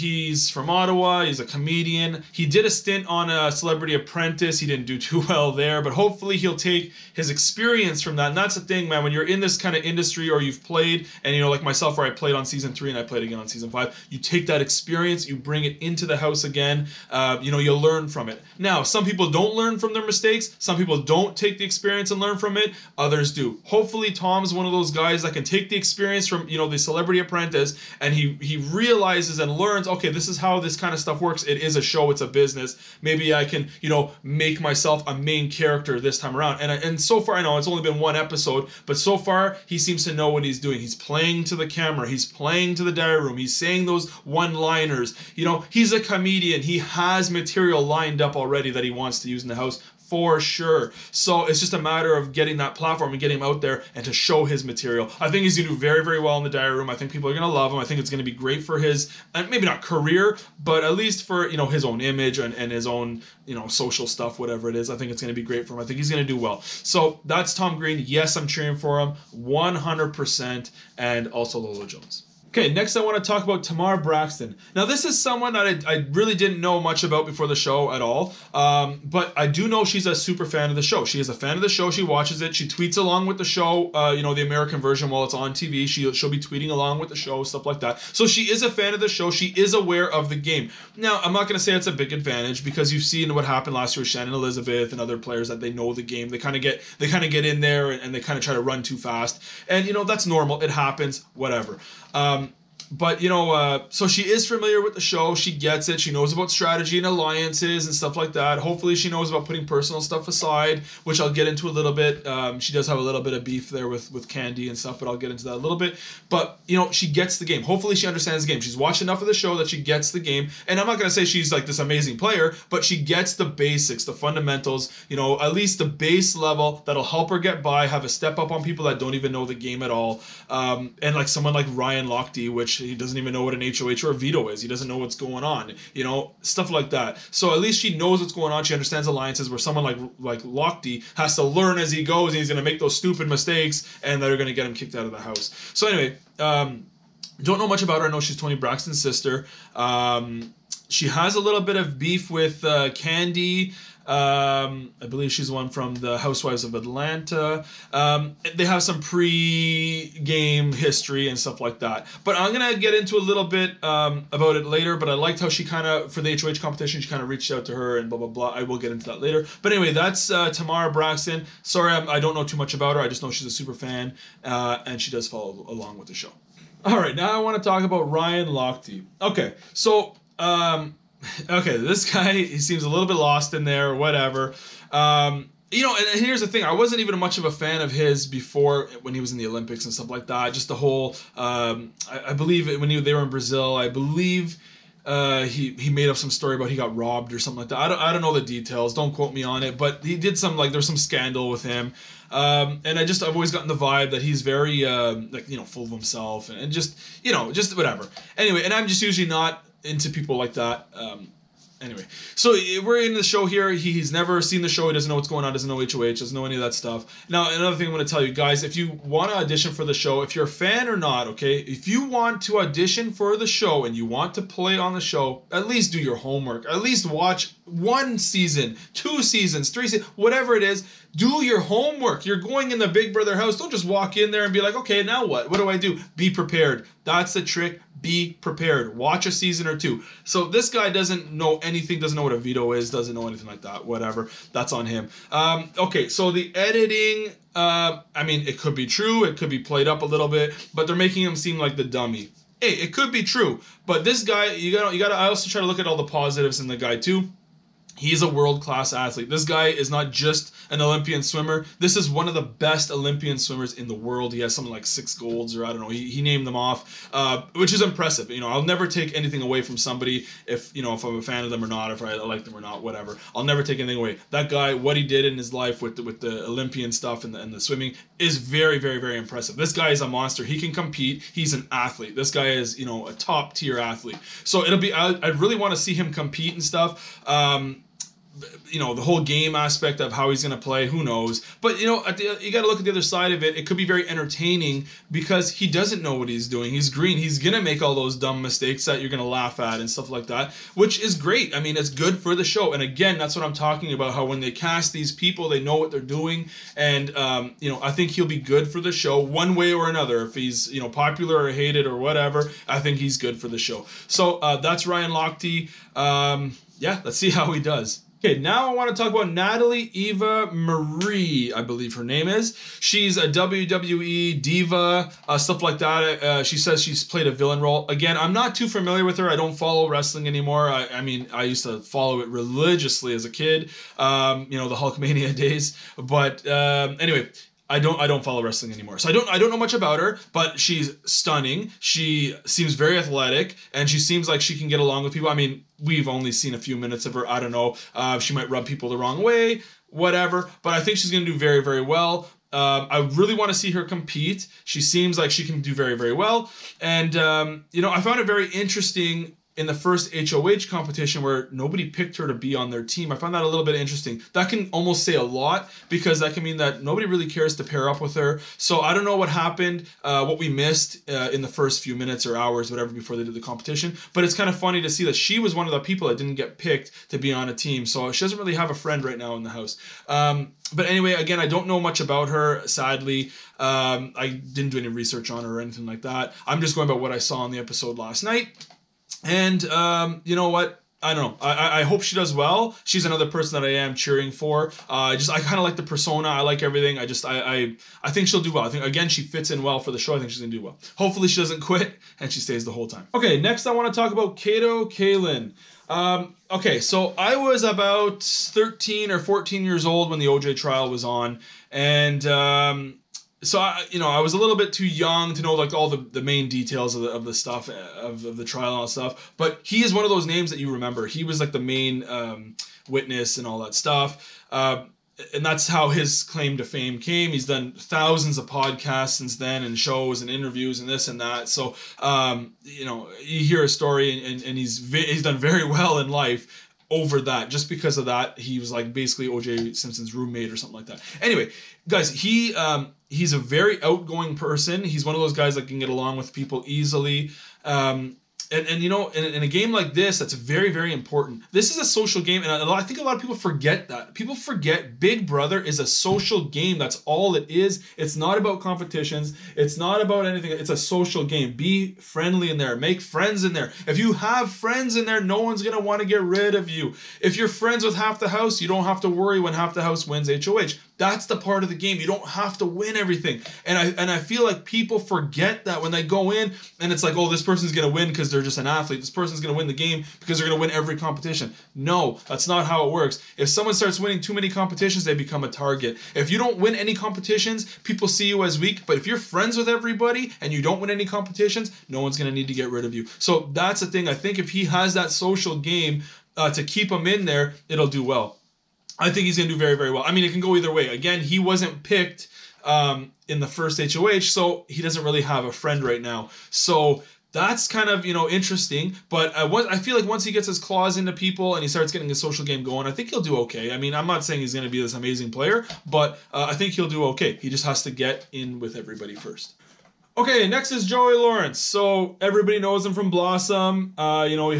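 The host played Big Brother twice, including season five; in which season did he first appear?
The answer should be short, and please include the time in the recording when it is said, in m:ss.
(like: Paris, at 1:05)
Season 3, at 0:12.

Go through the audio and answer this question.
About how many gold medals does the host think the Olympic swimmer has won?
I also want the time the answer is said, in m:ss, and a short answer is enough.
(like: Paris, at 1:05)
6, at 4:24.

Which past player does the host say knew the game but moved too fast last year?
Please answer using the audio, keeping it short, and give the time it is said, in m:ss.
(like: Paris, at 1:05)
Shannon Elizabeth, at 1:34.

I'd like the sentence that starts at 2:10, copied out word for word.
Um, and like someone like Ryan Lochte, which he doesn't even know what an HOH or a veto is.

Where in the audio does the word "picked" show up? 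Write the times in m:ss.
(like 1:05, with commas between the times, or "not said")
6:01, 6:16, 8:21.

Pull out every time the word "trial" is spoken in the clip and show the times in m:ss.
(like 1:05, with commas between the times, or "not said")
6:50, 6:58.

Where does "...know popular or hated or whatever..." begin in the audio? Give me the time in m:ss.
5:10.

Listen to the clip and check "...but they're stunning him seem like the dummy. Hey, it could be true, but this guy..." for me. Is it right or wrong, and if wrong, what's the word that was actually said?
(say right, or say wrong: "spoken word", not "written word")
wrong: "making", not "stunning".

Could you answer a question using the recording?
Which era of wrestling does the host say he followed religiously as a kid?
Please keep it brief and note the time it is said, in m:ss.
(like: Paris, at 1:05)
Hulkamania, at 5:34.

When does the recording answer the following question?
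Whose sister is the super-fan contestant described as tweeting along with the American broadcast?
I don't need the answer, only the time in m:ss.
2:28.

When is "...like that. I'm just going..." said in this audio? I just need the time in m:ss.
6:25.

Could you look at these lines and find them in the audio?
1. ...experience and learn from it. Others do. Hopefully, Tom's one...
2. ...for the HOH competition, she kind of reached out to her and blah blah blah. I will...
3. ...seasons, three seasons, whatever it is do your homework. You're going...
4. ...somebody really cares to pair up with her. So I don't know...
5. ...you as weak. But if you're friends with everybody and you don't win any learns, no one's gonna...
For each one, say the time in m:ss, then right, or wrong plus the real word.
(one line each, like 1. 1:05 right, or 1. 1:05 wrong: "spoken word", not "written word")
1. 0:21 right
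2. 2:46 right
3. 3:49 right
4. 6:06 wrong: "nobody", not "somebody"
5. 8:08 wrong: "competitions", not "learns".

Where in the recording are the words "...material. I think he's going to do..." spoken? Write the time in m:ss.
0:54.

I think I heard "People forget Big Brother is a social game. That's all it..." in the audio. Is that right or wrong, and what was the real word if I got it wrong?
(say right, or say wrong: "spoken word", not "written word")
right.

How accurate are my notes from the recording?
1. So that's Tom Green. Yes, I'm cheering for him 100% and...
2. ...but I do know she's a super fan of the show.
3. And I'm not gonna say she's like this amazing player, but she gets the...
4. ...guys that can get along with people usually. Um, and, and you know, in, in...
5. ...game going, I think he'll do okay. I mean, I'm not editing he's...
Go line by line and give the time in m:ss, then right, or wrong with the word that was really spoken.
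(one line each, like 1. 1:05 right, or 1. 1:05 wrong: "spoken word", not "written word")
1. 1:06 right
2. 1:19 right
3. 2:00 right
4. 7:25 wrong: "easily", not "usually"
5. 8:32 wrong: "saying", not "editing".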